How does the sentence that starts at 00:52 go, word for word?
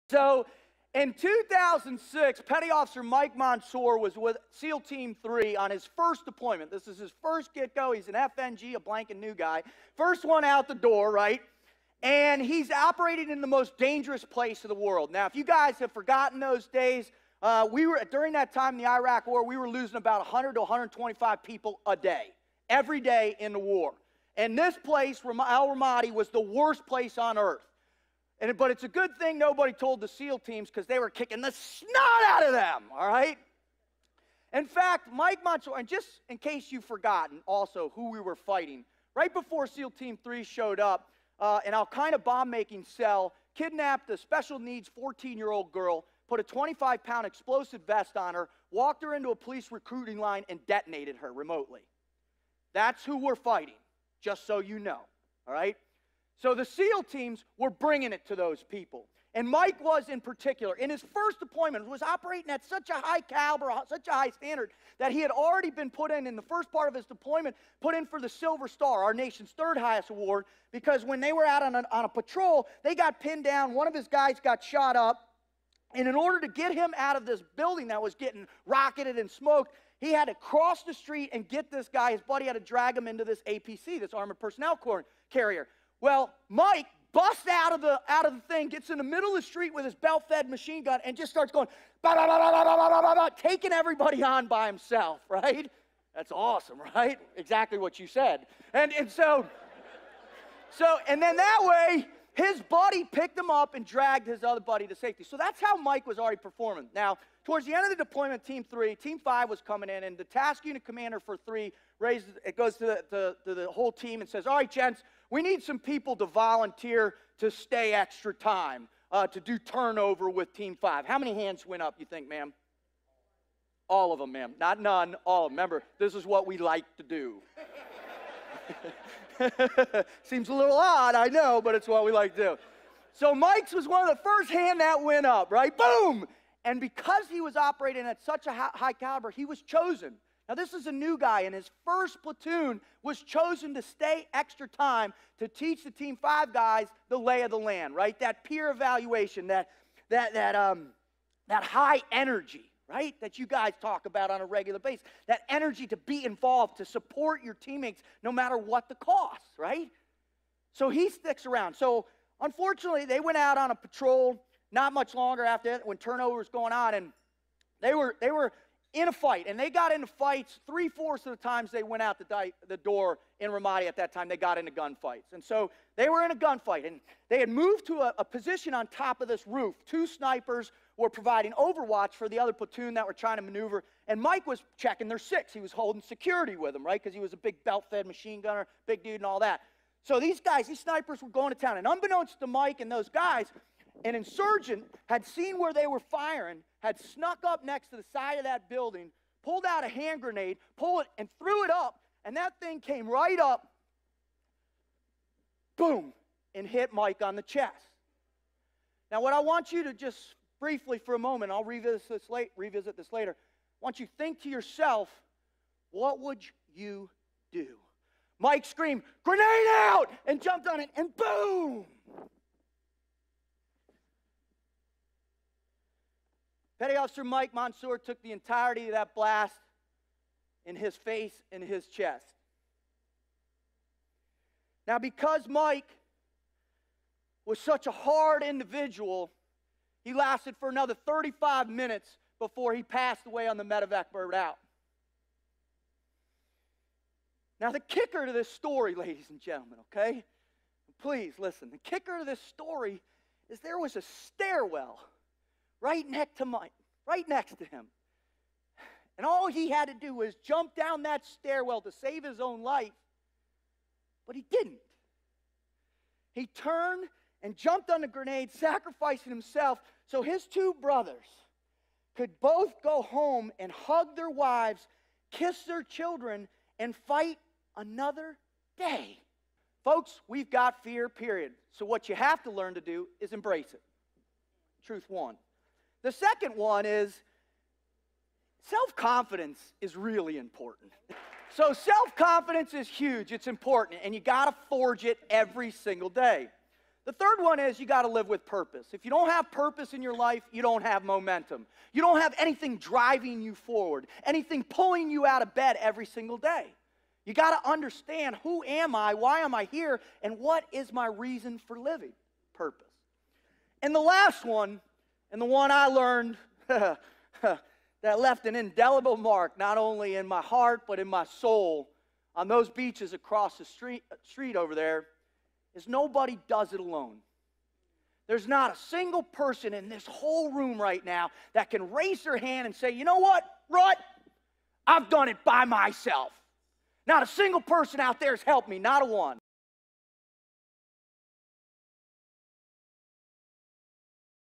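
That's who we're fighting, just so you know, all right?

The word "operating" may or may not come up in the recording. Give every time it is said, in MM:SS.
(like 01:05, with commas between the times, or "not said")
00:12, 01:02, 02:17.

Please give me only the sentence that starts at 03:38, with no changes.
Mike screamed, grenade out, and jumped on it, and boom!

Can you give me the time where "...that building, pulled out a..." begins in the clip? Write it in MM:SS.
03:18.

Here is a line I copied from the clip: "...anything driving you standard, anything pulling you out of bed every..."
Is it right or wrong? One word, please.
wrong.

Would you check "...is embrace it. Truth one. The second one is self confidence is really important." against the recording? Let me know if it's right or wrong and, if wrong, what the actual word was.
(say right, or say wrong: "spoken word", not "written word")
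right.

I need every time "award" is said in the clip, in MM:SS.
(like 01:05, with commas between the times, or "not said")
01:10.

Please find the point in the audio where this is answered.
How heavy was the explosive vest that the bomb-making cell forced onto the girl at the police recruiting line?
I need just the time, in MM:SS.
00:46.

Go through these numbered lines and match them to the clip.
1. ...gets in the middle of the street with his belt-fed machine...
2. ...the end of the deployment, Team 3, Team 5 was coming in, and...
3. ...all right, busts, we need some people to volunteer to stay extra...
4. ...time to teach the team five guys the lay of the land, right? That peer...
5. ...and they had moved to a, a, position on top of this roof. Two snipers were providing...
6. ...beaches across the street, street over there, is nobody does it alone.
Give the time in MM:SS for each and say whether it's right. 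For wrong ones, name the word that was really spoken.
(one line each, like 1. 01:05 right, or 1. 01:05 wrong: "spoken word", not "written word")
1. 01:28 right
2. 01:47 right
3. 01:54 wrong: "gents", not "busts"
4. 02:24 right
5. 02:56 right
6. 05:22 right.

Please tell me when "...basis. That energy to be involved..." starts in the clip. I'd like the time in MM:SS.
02:34.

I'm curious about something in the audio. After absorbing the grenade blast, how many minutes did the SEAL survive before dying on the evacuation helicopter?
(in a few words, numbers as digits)
35.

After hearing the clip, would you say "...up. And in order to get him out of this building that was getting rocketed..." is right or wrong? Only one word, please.
right.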